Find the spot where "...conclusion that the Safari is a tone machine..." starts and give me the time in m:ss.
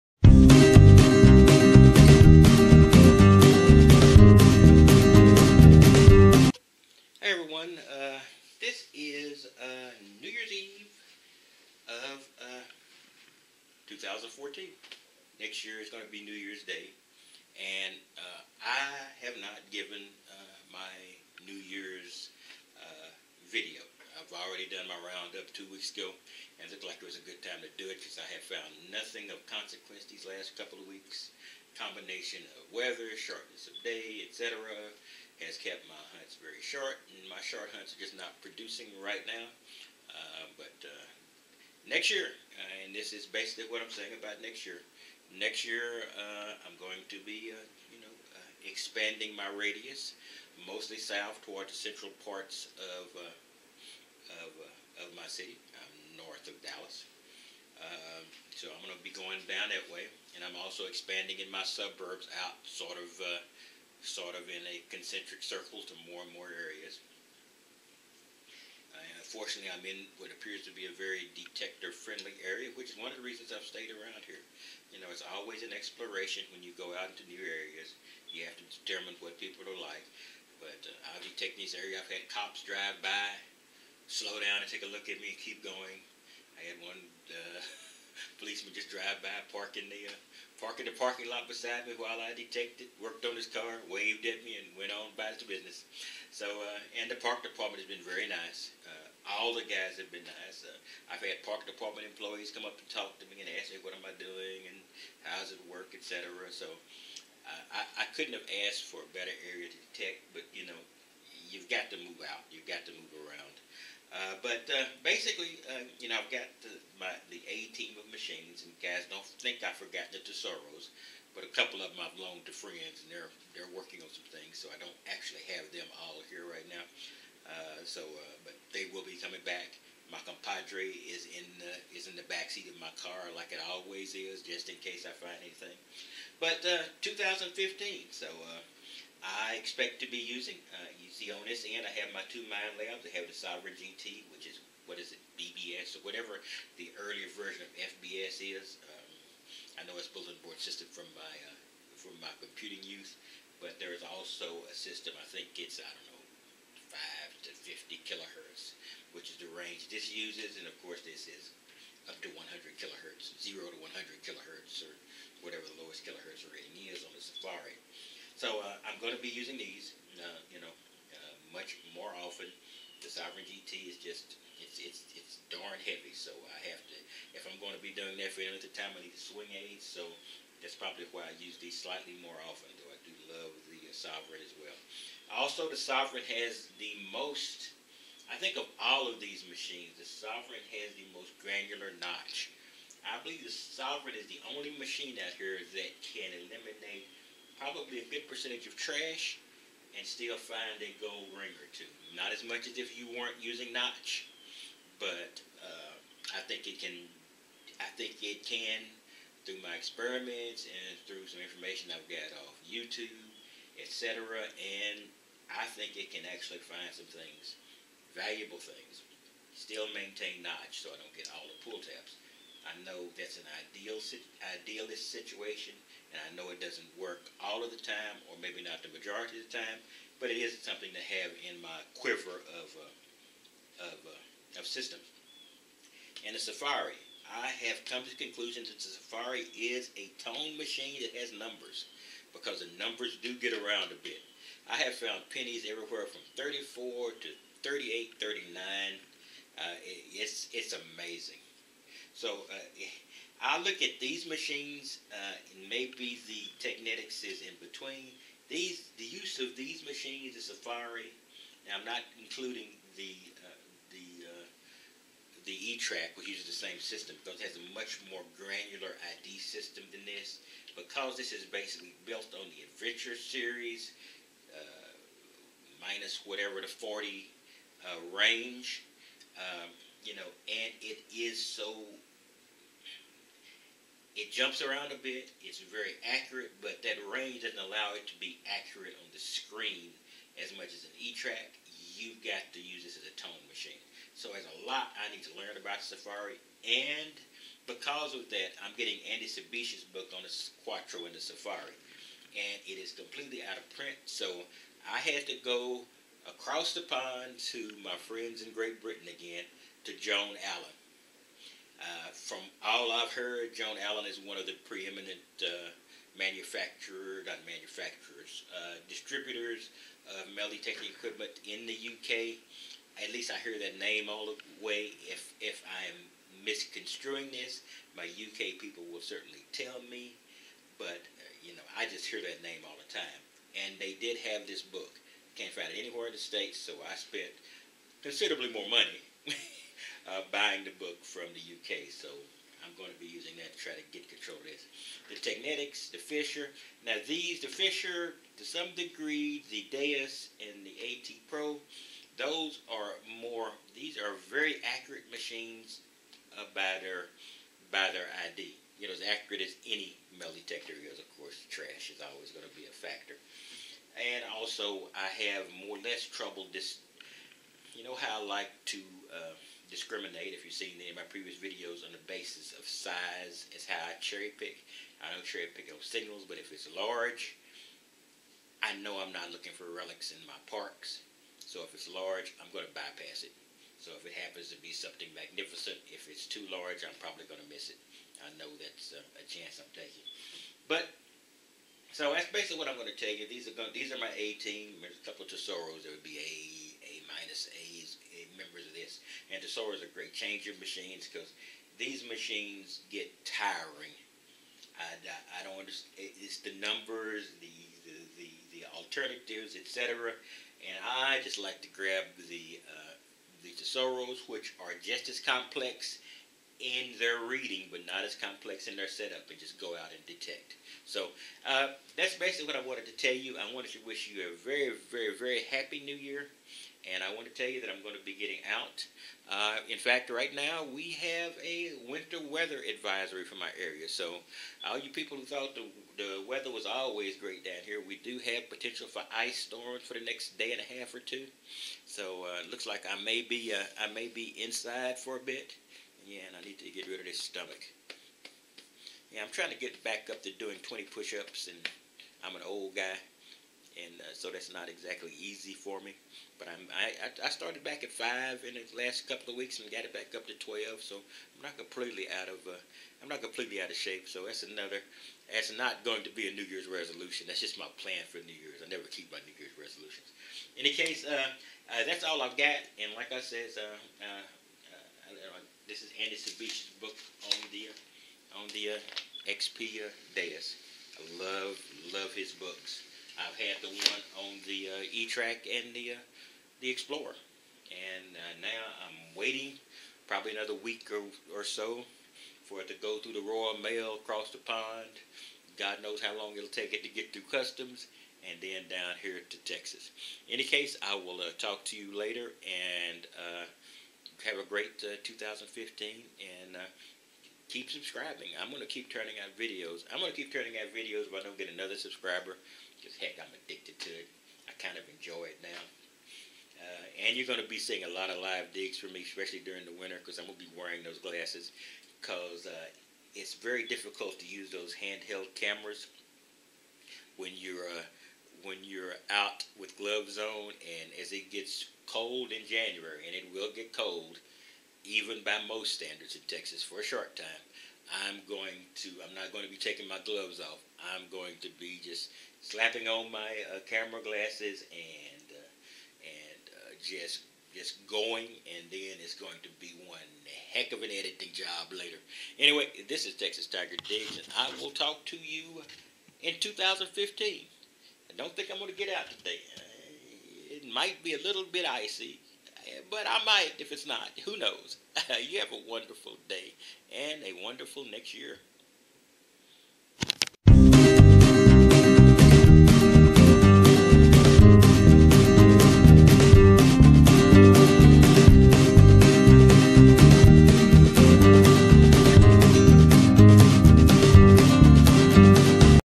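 3:58.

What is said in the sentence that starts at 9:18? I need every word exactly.
I don't think I'm going to get out today.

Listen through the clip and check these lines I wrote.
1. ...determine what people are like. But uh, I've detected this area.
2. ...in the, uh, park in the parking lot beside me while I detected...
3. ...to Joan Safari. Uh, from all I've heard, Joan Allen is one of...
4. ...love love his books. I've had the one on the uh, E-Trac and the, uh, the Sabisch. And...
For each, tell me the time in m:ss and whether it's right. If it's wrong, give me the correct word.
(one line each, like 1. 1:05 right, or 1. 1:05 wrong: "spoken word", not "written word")
1. 1:18 right
2. 1:29 right
3. 5:09 wrong: "Allen", not "Safari"
4. 8:01 wrong: "Explorer", not "Sabisch".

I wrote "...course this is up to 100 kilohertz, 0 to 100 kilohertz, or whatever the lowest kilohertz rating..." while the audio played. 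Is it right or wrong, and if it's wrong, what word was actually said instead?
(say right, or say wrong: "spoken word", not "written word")
right.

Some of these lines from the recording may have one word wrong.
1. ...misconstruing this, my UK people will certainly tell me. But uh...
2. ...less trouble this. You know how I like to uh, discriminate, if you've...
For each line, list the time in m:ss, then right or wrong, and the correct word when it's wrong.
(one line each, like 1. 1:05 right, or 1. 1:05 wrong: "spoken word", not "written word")
1. 5:26 right
2. 6:05 right.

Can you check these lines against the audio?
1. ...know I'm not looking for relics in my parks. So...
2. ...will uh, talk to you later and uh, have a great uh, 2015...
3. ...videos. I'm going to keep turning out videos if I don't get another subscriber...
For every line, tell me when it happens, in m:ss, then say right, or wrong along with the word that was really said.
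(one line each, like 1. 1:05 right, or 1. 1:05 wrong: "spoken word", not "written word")
1. 6:18 right
2. 8:20 right
3. 8:29 right.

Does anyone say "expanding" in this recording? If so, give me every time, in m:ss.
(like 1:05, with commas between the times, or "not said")
0:48, 1:00.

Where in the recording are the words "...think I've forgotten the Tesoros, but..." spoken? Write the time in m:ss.
1:59.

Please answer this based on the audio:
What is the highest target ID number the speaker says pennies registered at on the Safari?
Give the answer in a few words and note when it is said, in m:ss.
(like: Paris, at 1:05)
39, at 4:08.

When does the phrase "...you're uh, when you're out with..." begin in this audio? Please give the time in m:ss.
8:47.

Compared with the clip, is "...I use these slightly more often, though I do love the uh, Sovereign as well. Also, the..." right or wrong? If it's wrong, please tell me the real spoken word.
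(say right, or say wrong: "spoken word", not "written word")
right.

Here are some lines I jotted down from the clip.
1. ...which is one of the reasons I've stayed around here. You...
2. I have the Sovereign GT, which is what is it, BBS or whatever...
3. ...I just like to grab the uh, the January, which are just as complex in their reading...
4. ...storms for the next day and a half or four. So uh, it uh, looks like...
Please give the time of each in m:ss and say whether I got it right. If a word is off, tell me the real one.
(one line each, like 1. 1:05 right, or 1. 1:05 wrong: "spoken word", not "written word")
1. 1:12 right
2. 2:23 right
3. 6:50 wrong: "Tesoros", not "January"
4. 7:19 wrong: "two", not "four".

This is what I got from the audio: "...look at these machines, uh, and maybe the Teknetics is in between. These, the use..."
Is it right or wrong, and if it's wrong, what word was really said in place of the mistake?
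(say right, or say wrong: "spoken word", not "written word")
right.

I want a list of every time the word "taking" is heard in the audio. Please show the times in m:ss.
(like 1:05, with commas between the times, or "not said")
6:29, 8:59.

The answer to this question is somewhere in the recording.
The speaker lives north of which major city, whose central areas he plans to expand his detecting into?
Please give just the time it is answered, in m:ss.
0:56.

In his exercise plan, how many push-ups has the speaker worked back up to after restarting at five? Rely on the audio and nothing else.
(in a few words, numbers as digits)
12.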